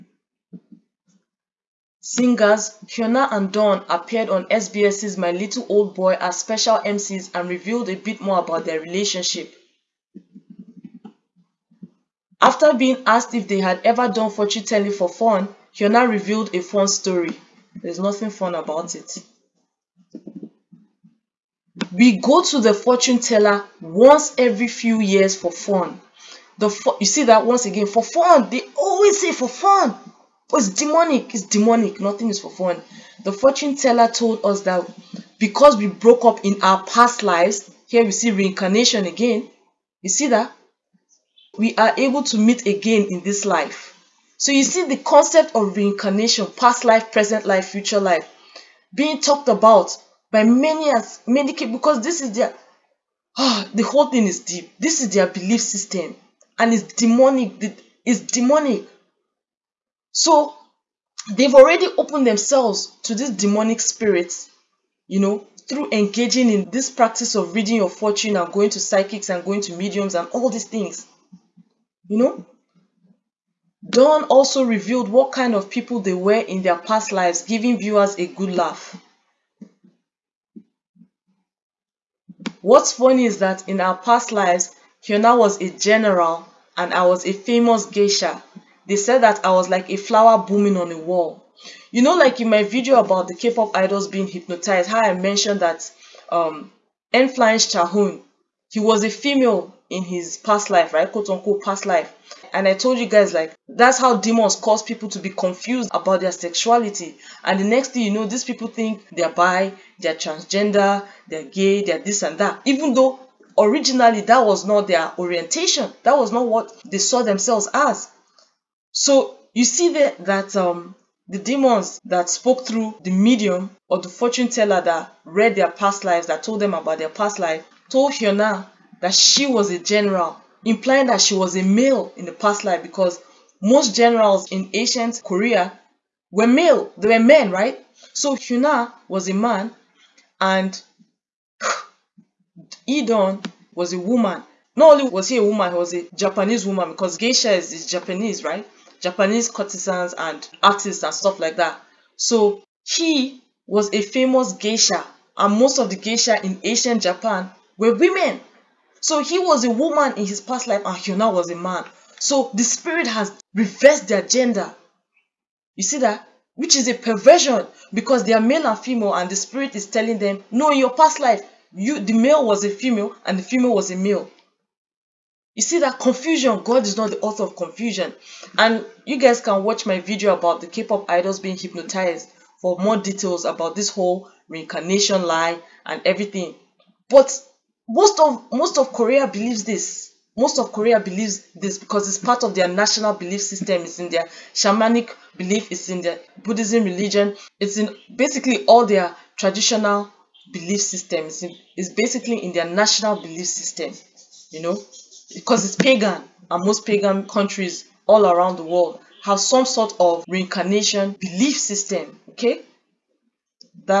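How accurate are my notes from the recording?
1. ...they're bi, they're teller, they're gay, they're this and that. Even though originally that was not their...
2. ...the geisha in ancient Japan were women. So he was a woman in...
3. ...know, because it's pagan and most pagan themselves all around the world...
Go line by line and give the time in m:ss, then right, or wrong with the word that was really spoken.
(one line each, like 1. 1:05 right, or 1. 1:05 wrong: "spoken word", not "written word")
1. 1:49 wrong: "transgender", not "teller"
2. 2:35 right
3. 3:24 wrong: "countries", not "themselves".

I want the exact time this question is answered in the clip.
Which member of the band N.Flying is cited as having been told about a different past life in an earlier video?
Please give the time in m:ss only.
1:37.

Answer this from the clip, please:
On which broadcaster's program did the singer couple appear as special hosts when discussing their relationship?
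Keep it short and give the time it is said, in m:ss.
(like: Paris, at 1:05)
SBS, at 0:04.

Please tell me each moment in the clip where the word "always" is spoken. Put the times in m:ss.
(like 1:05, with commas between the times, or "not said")
0:28.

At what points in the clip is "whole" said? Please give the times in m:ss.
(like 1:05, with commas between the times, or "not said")
0:53, 3:03.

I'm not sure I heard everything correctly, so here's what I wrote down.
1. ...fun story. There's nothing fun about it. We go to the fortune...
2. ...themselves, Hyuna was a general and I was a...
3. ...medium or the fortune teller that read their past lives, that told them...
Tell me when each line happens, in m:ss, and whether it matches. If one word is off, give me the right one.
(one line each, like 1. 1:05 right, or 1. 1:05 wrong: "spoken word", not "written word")
1. 0:16 right
2. 1:24 wrong: "lives", not "themselves"
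3. 2:03 right.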